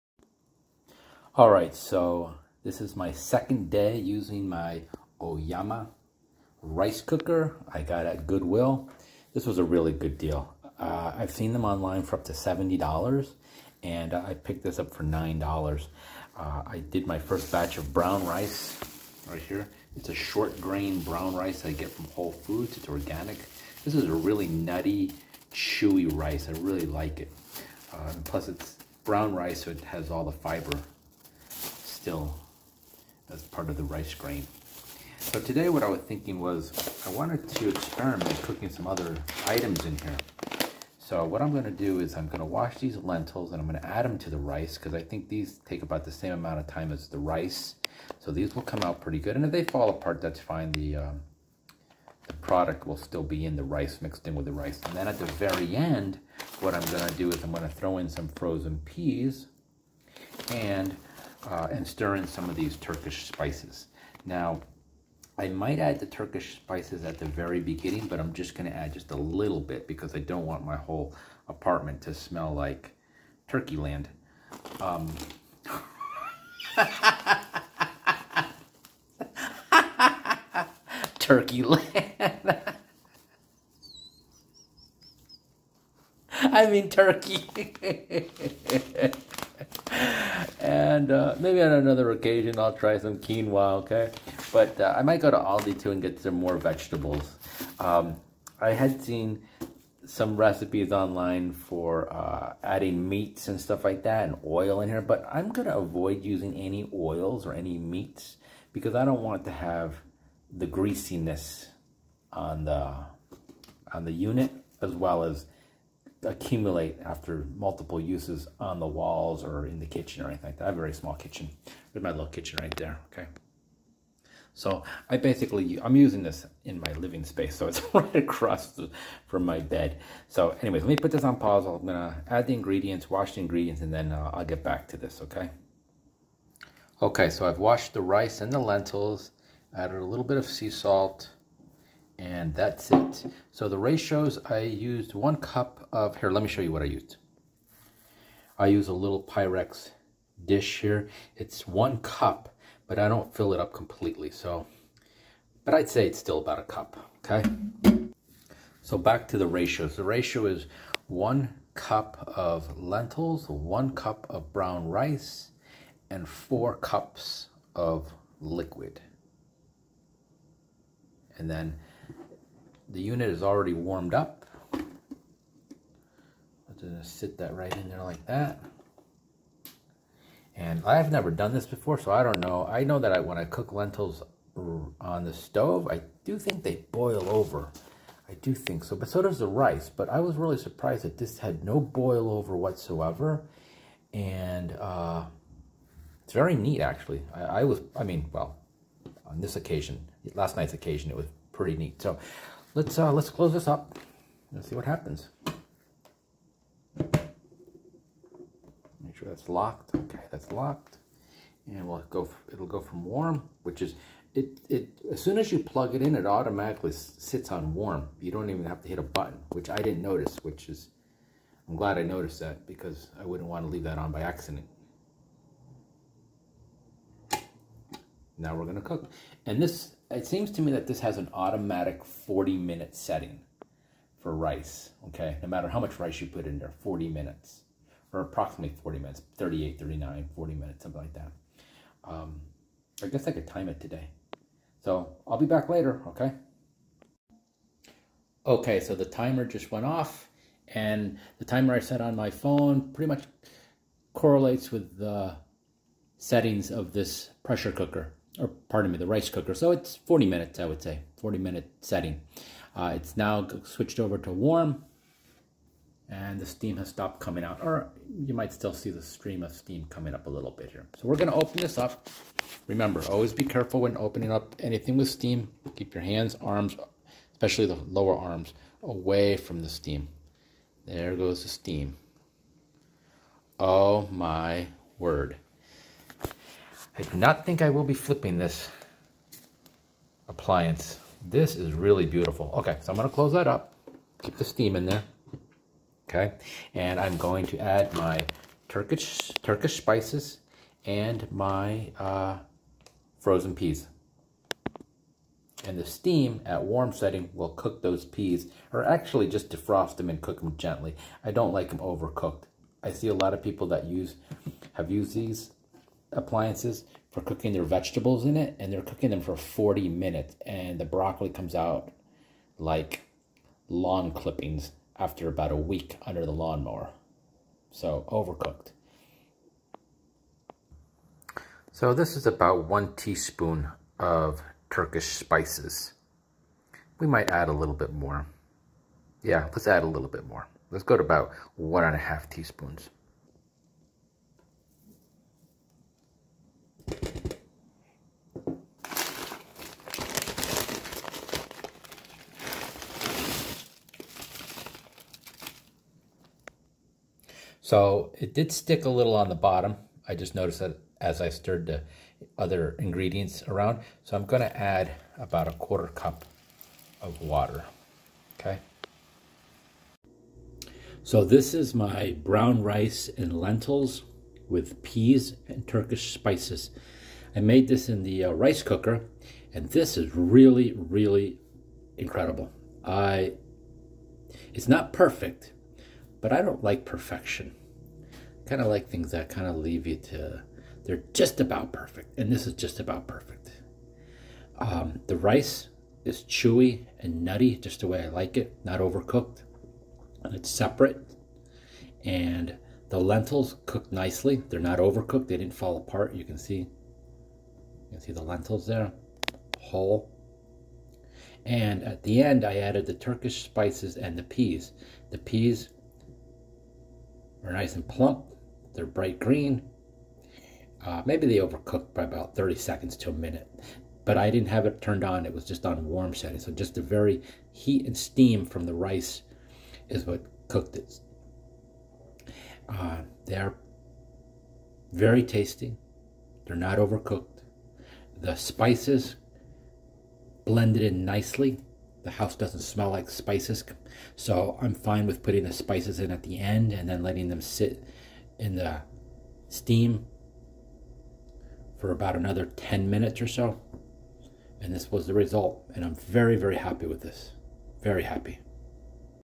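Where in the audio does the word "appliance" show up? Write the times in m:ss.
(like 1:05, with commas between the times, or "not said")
4:50, 5:16.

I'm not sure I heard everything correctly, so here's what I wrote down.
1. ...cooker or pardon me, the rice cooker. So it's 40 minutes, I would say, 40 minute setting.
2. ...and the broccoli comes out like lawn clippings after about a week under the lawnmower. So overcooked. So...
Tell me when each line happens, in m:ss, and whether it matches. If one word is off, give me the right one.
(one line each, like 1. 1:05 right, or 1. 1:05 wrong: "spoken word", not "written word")
1. 4:17 right
2. 5:20 right.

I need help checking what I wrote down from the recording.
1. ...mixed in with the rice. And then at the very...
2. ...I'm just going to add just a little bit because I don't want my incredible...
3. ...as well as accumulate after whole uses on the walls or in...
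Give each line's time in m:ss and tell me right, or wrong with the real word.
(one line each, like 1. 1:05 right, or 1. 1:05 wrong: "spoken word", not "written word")
1. 0:54 right
2. 1:08 wrong: "whole", not "incredible"
3. 1:54 wrong: "multiple", not "whole".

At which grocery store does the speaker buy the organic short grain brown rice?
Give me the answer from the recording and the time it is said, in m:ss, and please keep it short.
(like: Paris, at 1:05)
Whole Foods, at 0:22.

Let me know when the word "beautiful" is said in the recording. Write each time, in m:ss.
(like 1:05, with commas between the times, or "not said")
4:52.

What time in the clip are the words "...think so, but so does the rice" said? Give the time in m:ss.
3:08.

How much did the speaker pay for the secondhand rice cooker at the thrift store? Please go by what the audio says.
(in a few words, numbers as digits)
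$9.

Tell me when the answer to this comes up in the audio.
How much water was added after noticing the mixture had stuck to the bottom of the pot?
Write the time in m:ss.
6:05.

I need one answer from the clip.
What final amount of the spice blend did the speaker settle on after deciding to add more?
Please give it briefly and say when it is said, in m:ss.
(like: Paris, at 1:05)
1.5 teaspoons, at 5:41.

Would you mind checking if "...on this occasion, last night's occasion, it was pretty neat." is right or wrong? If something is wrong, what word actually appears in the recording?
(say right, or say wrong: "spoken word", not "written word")
right.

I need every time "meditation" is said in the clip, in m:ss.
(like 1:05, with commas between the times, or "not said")
not said.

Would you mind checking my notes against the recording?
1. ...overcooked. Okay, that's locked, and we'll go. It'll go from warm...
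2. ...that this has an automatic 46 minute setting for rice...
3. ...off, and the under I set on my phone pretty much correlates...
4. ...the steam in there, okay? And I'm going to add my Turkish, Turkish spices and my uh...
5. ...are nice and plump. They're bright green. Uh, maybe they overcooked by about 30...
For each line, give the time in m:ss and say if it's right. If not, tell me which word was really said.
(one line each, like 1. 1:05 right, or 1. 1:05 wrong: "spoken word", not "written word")
1. 3:29 wrong: "locked", not "overcooked"
2. 3:50 wrong: "40", not "46"
3. 4:09 wrong: "timer", not "under"
4. 4:54 right
5. 6:57 right.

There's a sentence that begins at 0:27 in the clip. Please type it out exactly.
Uh, plus, it's brown rice, so it has all the fiber still as part of the rice grain.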